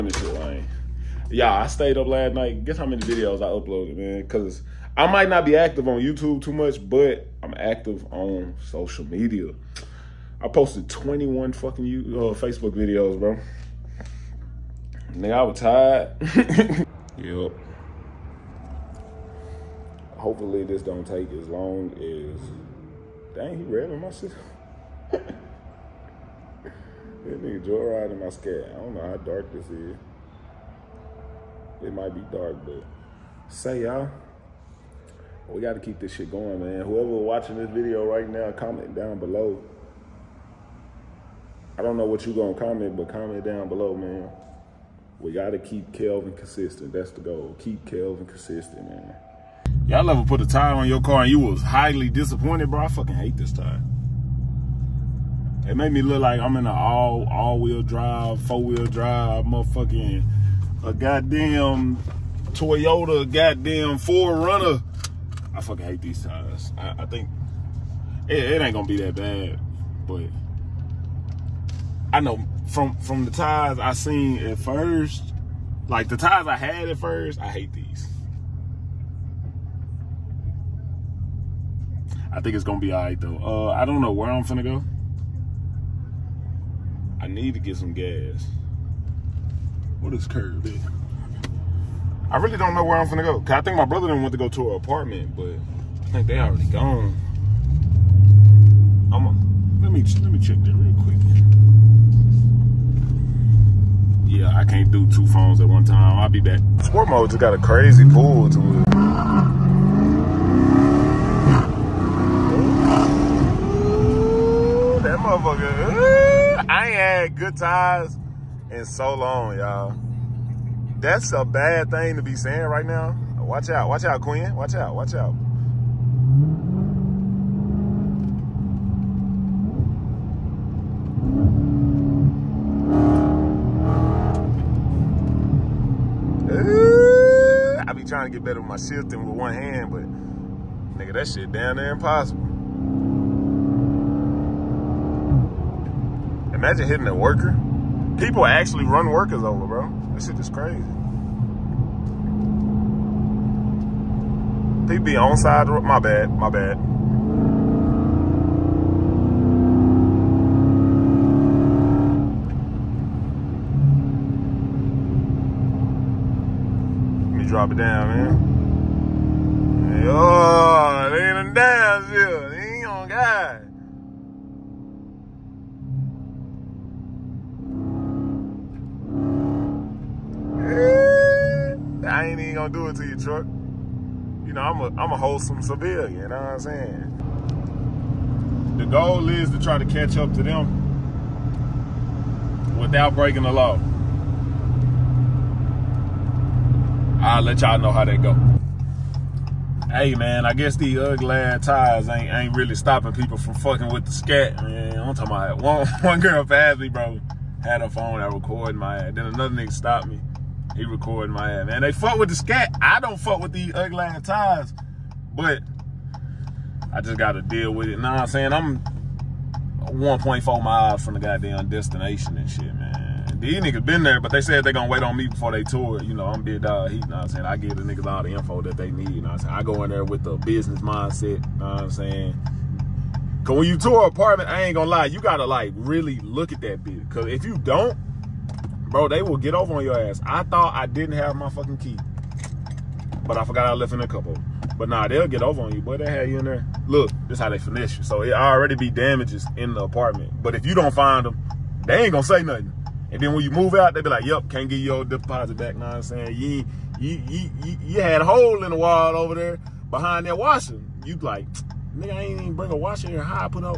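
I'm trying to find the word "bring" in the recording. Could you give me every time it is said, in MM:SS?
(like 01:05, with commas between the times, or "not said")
04:22.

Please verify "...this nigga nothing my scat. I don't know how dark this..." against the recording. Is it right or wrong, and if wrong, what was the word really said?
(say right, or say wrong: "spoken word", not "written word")
wrong: "joyriding", not "nothing".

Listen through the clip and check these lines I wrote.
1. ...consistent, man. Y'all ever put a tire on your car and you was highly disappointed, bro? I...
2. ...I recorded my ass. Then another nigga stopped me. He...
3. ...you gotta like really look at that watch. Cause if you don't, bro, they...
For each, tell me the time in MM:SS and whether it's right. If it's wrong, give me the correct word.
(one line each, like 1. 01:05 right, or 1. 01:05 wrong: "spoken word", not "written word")
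1. 00:48 right
2. 03:28 right
3. 03:55 wrong: "bitch", not "watch".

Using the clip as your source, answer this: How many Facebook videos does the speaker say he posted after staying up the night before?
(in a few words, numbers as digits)
21.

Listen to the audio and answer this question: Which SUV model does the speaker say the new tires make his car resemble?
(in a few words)
Toyota 4Runner.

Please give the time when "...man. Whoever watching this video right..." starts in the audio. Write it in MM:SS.
00:36.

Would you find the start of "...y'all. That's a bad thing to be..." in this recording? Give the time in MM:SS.
01:59.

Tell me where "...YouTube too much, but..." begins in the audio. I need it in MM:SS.
00:05.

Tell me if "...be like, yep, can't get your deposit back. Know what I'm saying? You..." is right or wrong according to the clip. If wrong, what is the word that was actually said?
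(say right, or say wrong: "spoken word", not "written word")
right.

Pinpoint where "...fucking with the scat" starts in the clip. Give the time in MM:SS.
03:23.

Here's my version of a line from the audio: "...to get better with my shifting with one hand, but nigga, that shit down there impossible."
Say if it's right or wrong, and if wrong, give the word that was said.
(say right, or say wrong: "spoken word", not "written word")
right.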